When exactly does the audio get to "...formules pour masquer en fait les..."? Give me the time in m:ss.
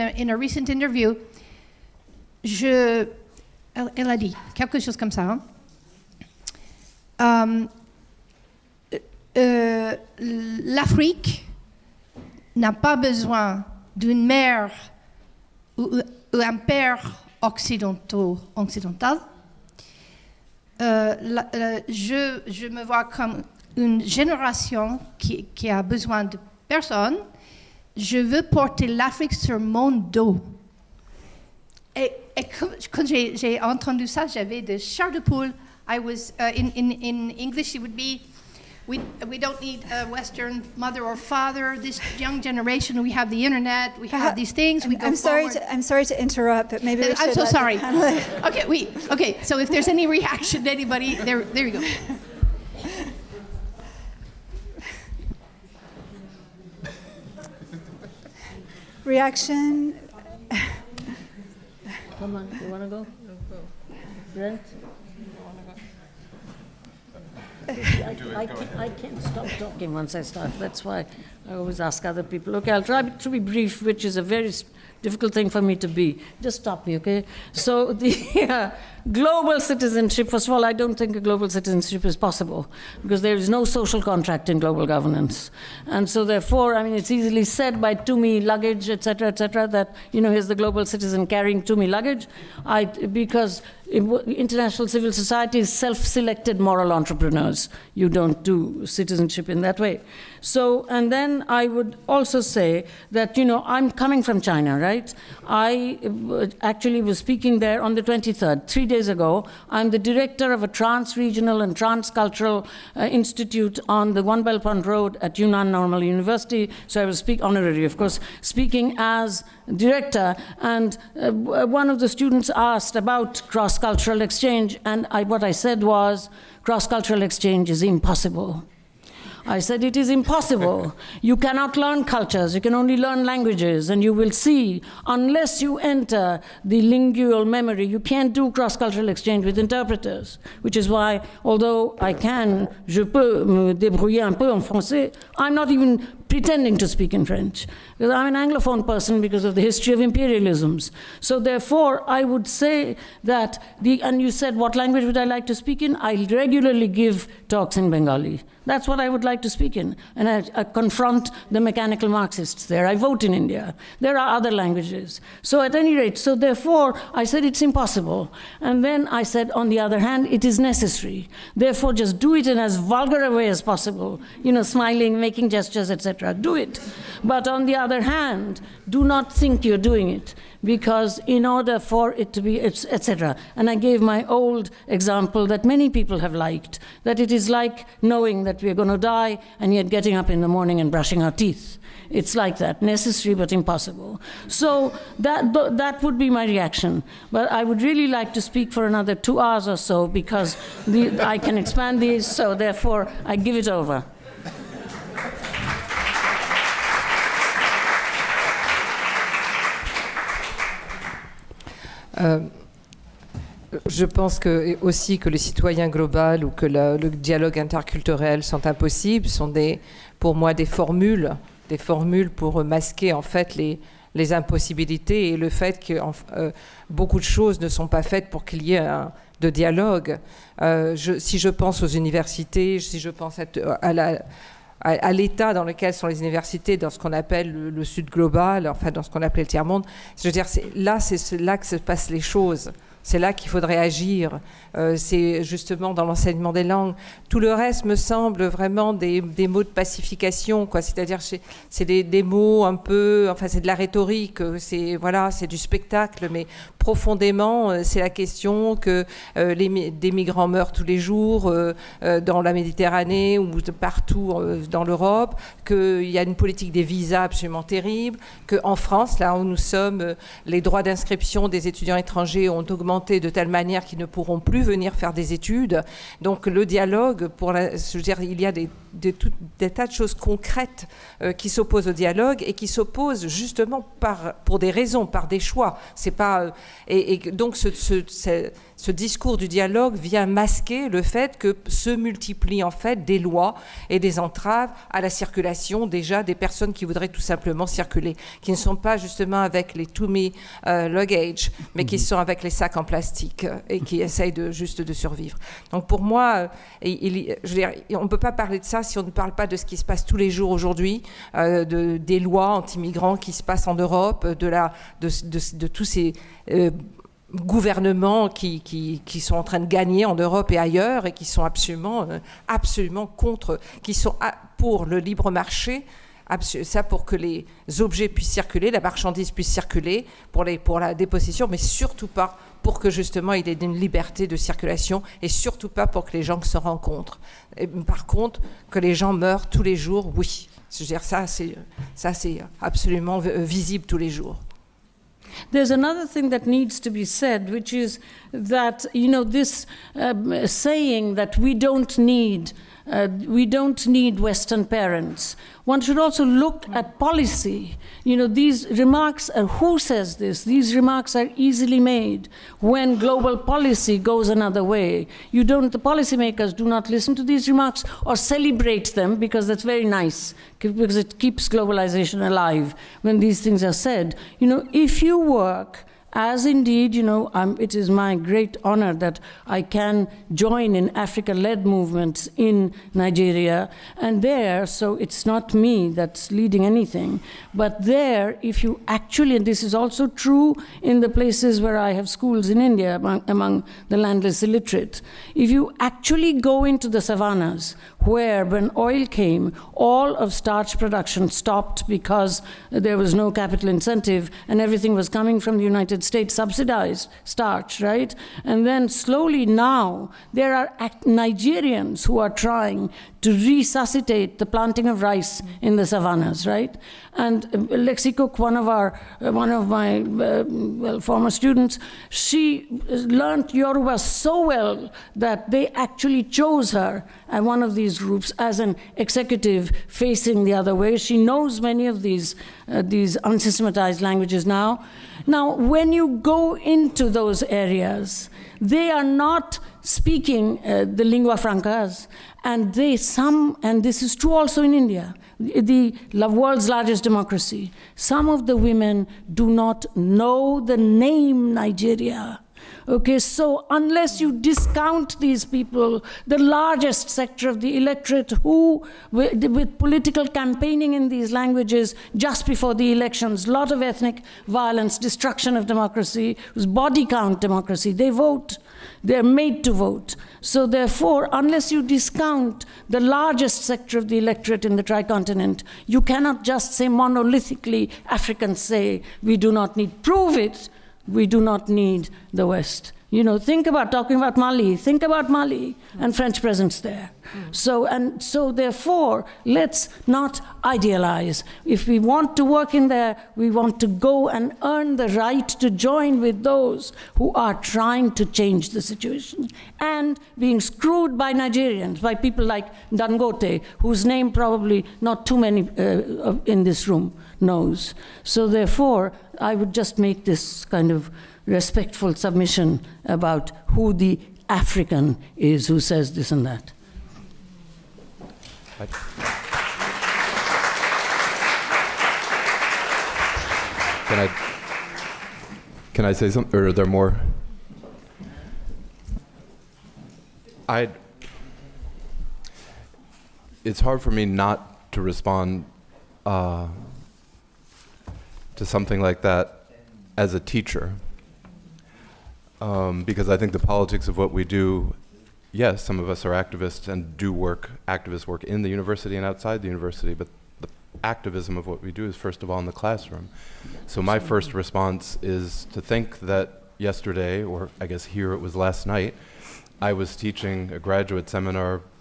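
3:41.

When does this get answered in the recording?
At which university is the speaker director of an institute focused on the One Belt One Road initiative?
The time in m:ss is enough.
1:55.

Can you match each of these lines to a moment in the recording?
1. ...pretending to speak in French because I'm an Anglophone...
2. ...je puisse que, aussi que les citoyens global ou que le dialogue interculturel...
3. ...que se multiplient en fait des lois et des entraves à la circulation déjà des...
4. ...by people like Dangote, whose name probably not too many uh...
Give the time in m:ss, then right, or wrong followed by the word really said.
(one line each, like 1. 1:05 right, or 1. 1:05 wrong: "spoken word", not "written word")
1. 2:26 right
2. 3:33 wrong: "pense", not "puisse"
3. 4:51 right
4. 8:22 right.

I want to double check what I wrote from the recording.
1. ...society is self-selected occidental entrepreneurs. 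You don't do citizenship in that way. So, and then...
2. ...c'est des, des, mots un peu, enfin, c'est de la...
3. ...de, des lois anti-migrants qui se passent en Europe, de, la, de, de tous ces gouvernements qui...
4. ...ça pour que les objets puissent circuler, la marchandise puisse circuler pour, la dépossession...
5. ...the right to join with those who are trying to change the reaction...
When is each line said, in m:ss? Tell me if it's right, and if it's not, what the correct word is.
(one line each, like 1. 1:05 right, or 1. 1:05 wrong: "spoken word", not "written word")
1. 1:35 wrong: "moral", not "occidental"
2. 4:11 right
3. 5:11 right
4. 5:26 right
5. 8:14 wrong: "situation", not "reaction".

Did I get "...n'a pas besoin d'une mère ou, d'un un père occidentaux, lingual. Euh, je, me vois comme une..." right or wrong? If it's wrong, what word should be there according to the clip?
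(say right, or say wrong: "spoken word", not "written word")
wrong: "occidental", not "lingual".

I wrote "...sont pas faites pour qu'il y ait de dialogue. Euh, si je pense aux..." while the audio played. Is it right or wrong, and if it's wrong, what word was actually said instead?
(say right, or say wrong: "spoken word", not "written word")
right.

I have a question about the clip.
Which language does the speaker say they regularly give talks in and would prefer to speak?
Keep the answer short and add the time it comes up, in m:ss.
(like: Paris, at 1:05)
Bengali, at 2:37.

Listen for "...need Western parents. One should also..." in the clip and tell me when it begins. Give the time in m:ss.
5:53.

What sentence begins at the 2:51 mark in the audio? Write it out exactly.
Therefore, just do it in as vulgar a way as possible.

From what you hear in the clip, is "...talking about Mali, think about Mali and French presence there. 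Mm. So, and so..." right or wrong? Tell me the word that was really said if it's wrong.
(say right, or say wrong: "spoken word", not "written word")
right.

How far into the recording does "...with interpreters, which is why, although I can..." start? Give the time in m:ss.
2:19.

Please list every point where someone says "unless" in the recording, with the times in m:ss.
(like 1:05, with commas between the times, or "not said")
2:15, 7:33, 7:51.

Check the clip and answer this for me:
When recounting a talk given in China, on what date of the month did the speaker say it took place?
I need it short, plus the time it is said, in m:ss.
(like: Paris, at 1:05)
23rd, at 1:48.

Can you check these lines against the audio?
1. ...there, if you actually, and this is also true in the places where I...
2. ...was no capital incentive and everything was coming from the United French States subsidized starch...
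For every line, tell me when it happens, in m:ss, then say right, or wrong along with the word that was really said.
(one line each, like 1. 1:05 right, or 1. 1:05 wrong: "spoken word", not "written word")
1. 6:27 right
2. 6:42 wrong: "United", not "French".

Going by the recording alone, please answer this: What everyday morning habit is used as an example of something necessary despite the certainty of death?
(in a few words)
brushing our teeth.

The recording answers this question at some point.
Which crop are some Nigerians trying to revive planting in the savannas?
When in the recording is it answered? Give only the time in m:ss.
6:55.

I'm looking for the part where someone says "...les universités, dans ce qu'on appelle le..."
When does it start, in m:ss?
3:56.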